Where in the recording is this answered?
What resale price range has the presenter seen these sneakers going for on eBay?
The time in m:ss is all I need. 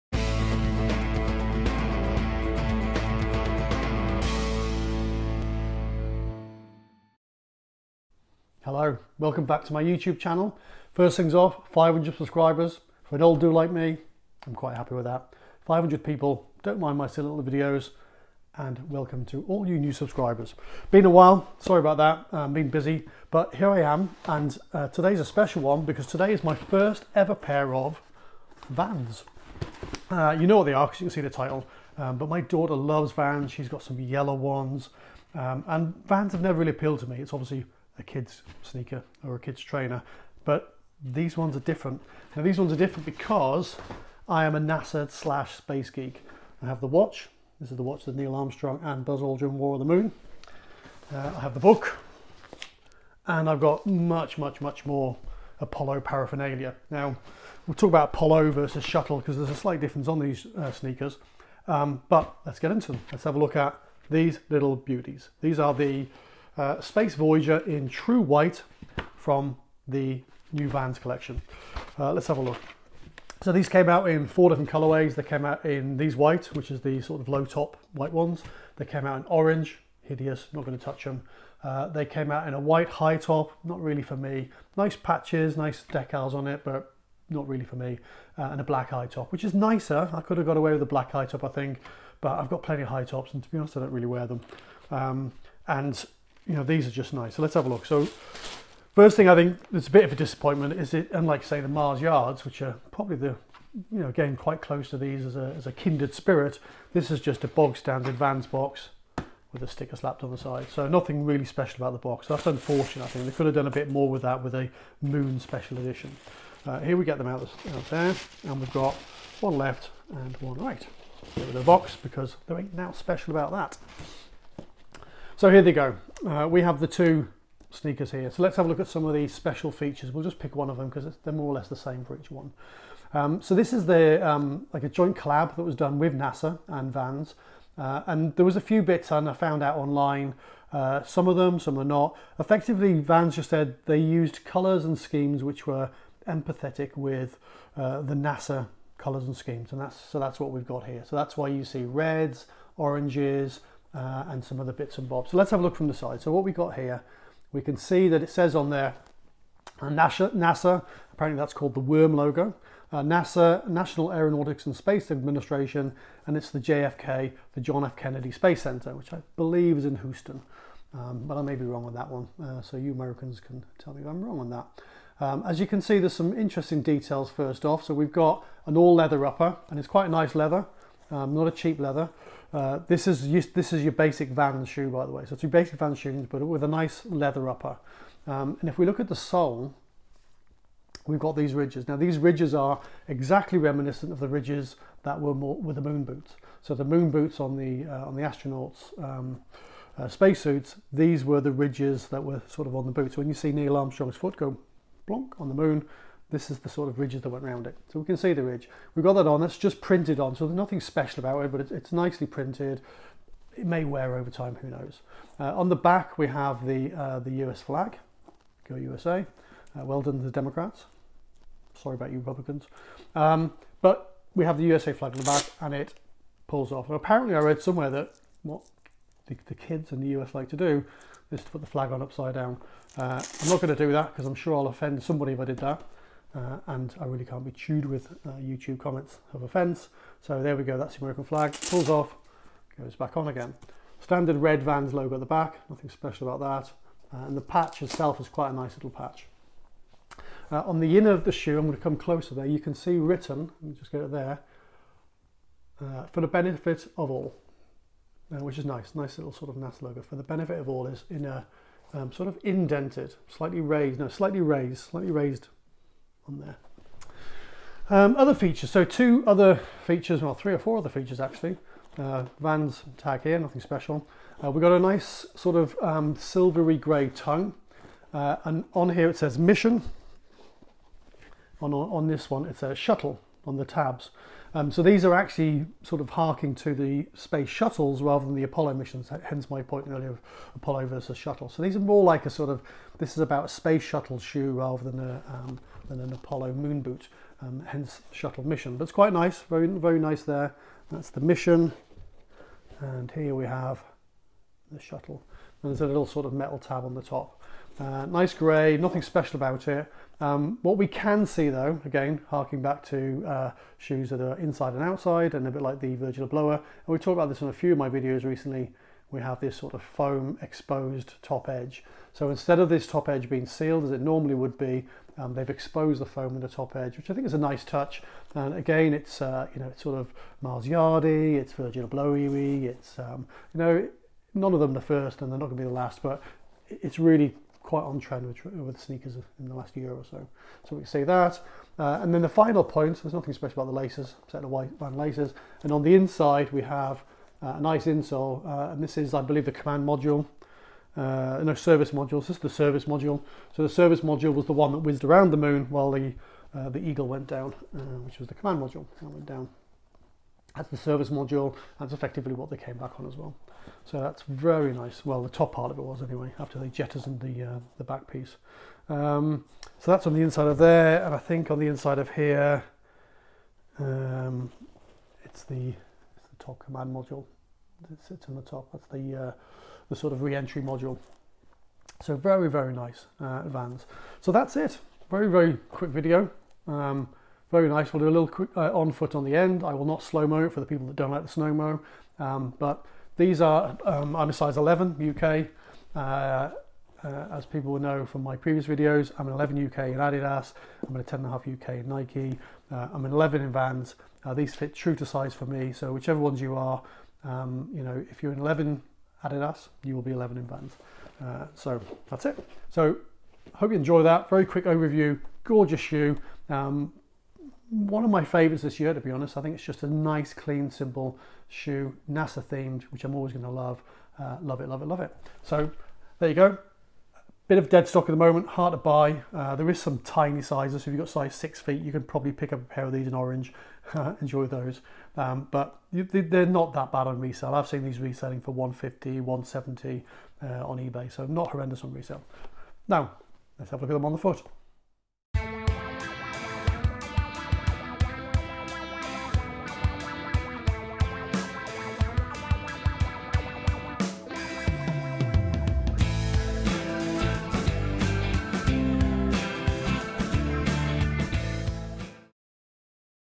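7:18.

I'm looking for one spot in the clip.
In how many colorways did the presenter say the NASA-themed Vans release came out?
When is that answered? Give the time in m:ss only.
1:14.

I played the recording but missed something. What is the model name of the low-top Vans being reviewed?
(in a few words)
Space Voyager.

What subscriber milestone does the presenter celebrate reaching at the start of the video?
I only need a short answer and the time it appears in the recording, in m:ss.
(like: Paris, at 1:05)
500, at 0:11.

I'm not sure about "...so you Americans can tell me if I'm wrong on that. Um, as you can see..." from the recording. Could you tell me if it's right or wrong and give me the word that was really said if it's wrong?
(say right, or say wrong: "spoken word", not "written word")
right.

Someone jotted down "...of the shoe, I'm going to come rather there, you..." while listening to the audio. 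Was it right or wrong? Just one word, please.
wrong.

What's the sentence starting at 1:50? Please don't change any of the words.
So nothing really special about the box.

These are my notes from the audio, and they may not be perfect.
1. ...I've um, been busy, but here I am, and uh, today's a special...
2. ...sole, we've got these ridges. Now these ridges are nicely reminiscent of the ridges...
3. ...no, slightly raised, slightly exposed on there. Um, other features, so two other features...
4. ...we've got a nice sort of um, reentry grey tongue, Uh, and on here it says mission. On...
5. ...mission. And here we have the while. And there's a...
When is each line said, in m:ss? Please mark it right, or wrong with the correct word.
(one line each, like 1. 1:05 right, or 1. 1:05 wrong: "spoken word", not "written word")
1. 0:22 right
2. 3:09 wrong: "exactly", not "nicely"
3. 4:23 wrong: "raised", not "exposed"
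4. 4:34 wrong: "silvery", not "reentry"
5. 5:01 wrong: "shuttle", not "while".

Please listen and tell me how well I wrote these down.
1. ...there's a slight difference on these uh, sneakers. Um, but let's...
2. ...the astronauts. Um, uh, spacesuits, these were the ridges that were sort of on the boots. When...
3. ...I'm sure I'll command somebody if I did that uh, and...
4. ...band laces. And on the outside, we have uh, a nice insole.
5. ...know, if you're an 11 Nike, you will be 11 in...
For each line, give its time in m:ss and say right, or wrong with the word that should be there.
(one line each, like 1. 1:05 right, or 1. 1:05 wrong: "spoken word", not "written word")
1. 0:59 right
2. 3:18 right
3. 3:54 wrong: "offend", not "command"
4. 5:44 wrong: "inside", not "outside"
5. 6:47 wrong: "Adidas", not "Nike".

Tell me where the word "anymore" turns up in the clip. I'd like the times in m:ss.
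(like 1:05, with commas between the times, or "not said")
not said.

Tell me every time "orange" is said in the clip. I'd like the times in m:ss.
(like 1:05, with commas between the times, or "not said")
1:19, 2:32, 7:13.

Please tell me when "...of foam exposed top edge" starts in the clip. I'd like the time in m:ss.
5:19.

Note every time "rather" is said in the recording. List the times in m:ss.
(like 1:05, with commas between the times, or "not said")
4:48, 4:54.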